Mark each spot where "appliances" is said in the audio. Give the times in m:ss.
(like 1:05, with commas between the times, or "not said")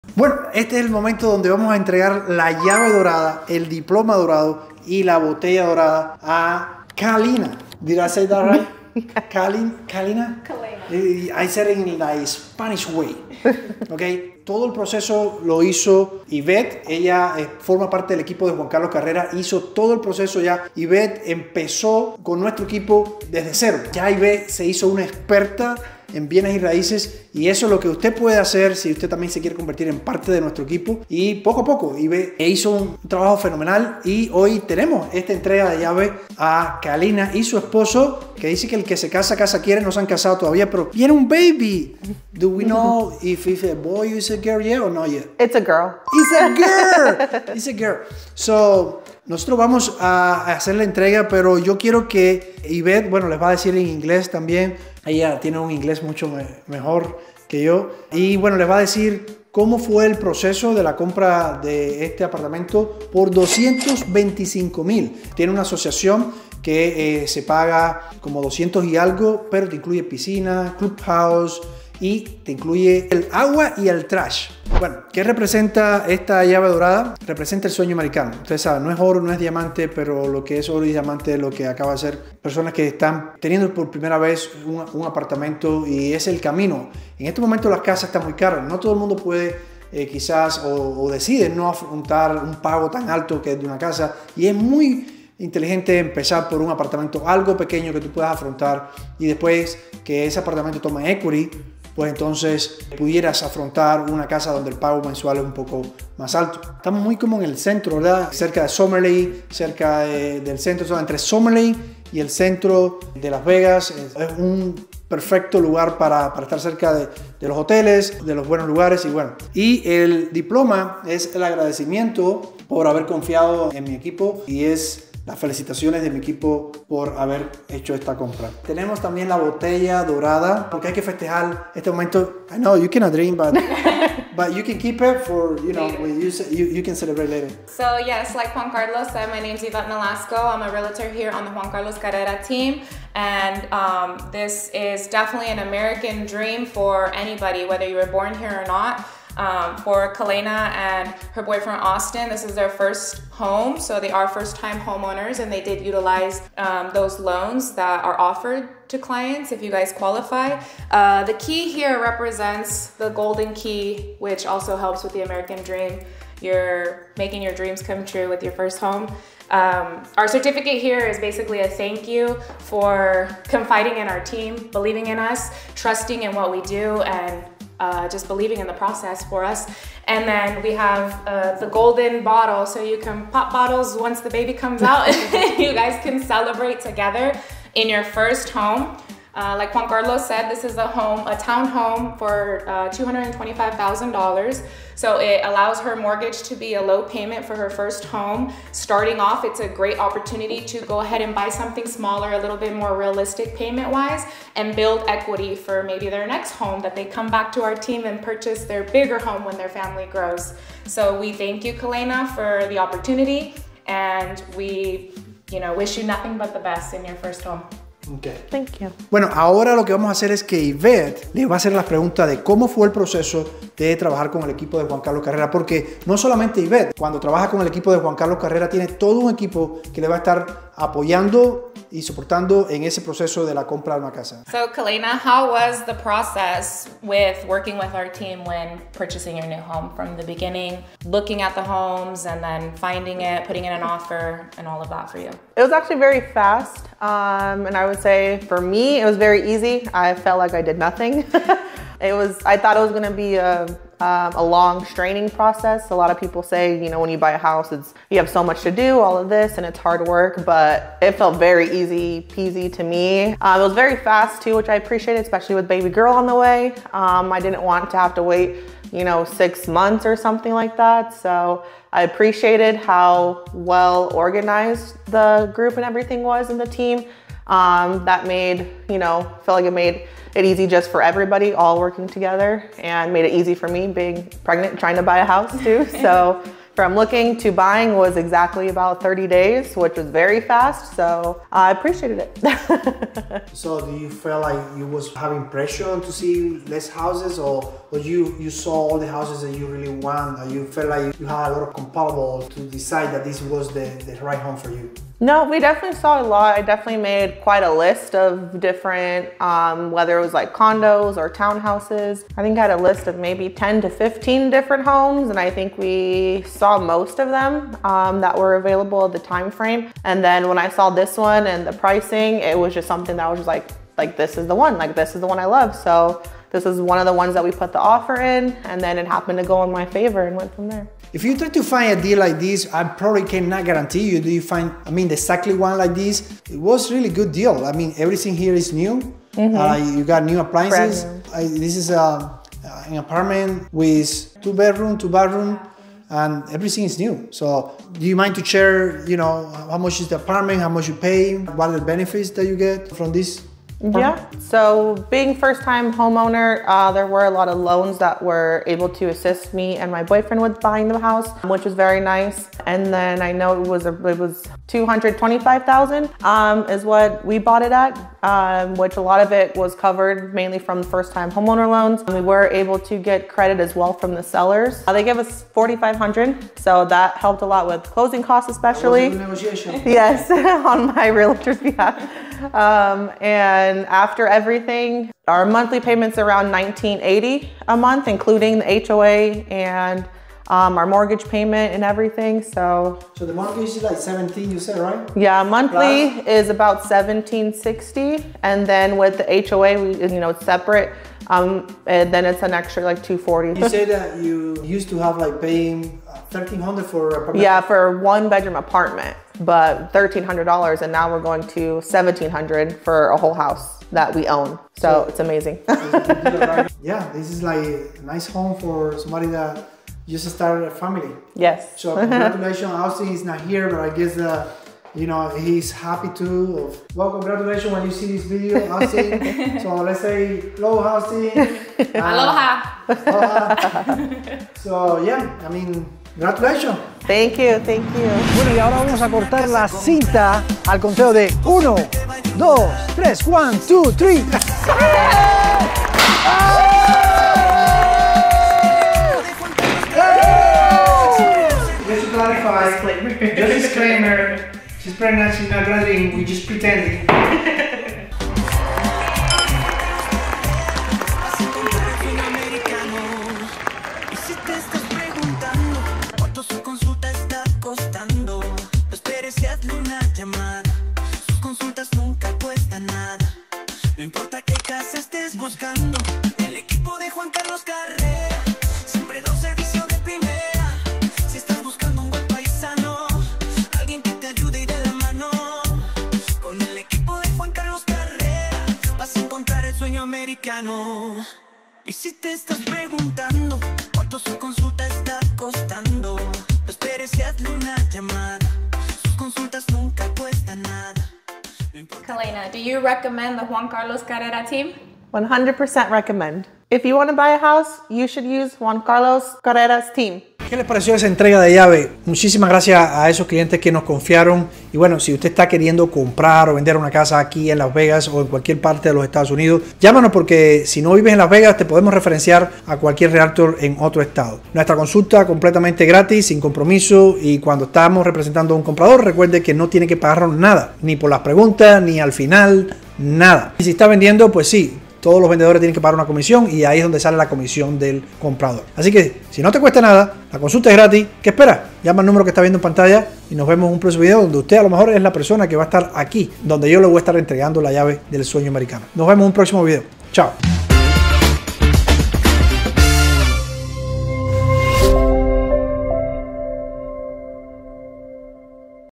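5:40.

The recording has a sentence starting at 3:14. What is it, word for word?
So it allows her mortgage to be a low payment for her first home.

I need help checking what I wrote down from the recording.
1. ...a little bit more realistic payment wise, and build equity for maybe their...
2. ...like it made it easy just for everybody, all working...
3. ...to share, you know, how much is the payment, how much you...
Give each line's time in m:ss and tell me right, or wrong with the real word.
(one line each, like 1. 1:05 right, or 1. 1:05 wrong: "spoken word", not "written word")
1. 3:22 right
2. 4:39 right
3. 5:48 wrong: "apartment", not "payment".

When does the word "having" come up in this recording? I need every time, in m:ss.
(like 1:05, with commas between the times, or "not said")
4:55.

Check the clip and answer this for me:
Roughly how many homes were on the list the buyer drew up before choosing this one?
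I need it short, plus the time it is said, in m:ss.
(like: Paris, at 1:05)
10 to 15, at 5:13.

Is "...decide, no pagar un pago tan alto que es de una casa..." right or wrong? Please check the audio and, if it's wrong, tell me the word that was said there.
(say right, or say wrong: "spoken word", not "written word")
wrong: "afrontar", not "pagar".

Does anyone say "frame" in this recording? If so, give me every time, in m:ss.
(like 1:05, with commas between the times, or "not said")
5:19.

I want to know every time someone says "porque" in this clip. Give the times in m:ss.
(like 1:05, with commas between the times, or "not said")
2:10, 3:45, 8:40.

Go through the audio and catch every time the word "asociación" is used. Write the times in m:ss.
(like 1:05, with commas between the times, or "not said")
1:05.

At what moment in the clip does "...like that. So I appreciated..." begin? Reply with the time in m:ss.
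4:30.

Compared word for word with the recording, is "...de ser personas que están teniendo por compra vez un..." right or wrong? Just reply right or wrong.
wrong.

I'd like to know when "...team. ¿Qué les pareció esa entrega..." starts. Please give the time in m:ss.
8:29.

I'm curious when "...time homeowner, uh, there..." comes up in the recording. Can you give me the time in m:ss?
5:55.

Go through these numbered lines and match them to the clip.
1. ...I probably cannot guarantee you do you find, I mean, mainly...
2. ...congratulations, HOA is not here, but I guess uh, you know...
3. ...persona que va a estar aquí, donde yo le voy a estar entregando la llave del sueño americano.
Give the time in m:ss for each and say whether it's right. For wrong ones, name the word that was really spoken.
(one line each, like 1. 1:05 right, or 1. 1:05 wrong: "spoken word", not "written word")
1. 5:32 wrong: "exactly", not "mainly"
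2. 7:01 wrong: "Austin", not "HOA"
3. 9:05 right.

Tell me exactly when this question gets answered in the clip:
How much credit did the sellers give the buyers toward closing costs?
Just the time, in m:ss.
6:15.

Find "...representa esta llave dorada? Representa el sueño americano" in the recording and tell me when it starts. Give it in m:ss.
1:15.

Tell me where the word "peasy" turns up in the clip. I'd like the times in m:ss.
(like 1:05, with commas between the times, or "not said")
4:22.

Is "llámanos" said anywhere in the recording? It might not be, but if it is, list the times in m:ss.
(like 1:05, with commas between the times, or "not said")
8:39.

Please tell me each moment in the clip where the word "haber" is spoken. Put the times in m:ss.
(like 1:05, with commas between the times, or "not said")
2:02, 2:07.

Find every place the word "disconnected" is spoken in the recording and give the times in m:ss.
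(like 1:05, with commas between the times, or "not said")
not said.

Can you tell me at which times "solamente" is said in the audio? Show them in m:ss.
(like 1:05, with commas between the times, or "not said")
3:46.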